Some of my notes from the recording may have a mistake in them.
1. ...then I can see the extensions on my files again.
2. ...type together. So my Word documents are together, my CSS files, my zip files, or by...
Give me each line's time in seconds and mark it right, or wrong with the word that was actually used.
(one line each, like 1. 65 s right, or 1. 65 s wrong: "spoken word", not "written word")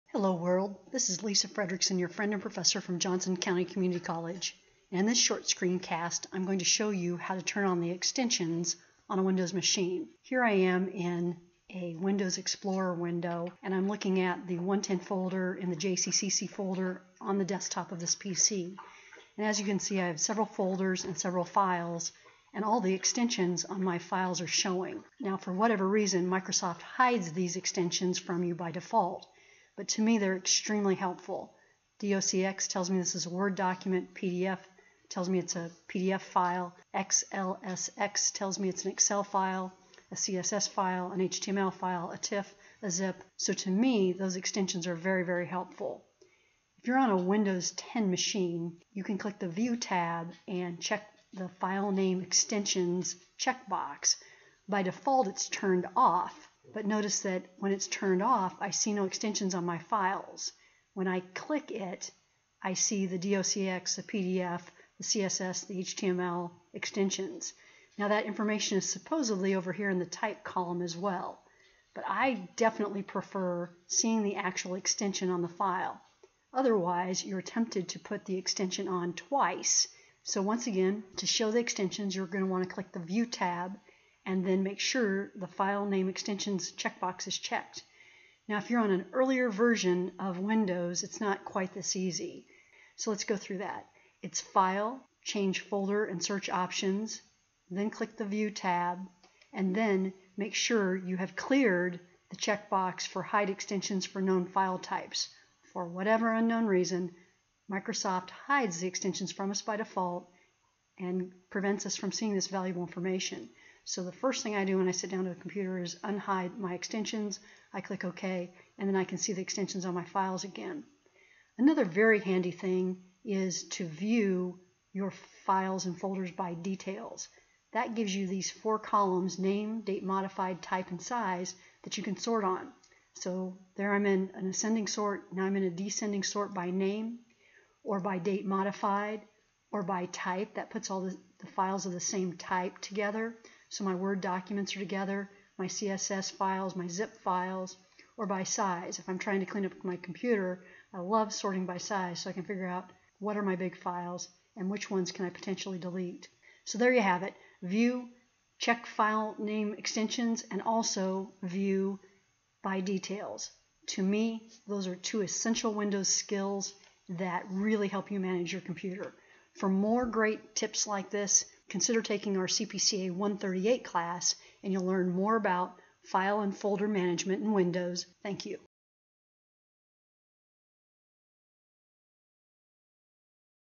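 1. 118 s right
2. 142 s right.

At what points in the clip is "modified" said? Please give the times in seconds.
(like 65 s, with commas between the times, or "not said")
130 s, 138 s.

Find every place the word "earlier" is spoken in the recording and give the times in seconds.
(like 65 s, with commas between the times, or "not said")
89 s.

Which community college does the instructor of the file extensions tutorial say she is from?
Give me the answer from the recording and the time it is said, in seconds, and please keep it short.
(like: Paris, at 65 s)
Johnson County Community College, at 2 s.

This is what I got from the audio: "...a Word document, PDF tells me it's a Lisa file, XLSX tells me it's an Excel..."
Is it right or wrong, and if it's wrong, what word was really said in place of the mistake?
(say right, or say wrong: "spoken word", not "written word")
wrong: "PDF", not "Lisa".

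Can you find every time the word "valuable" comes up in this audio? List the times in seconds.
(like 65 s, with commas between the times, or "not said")
112 s.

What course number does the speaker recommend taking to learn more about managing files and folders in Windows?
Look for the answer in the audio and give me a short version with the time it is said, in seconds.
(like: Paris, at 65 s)
CPCA 138, at 172 s.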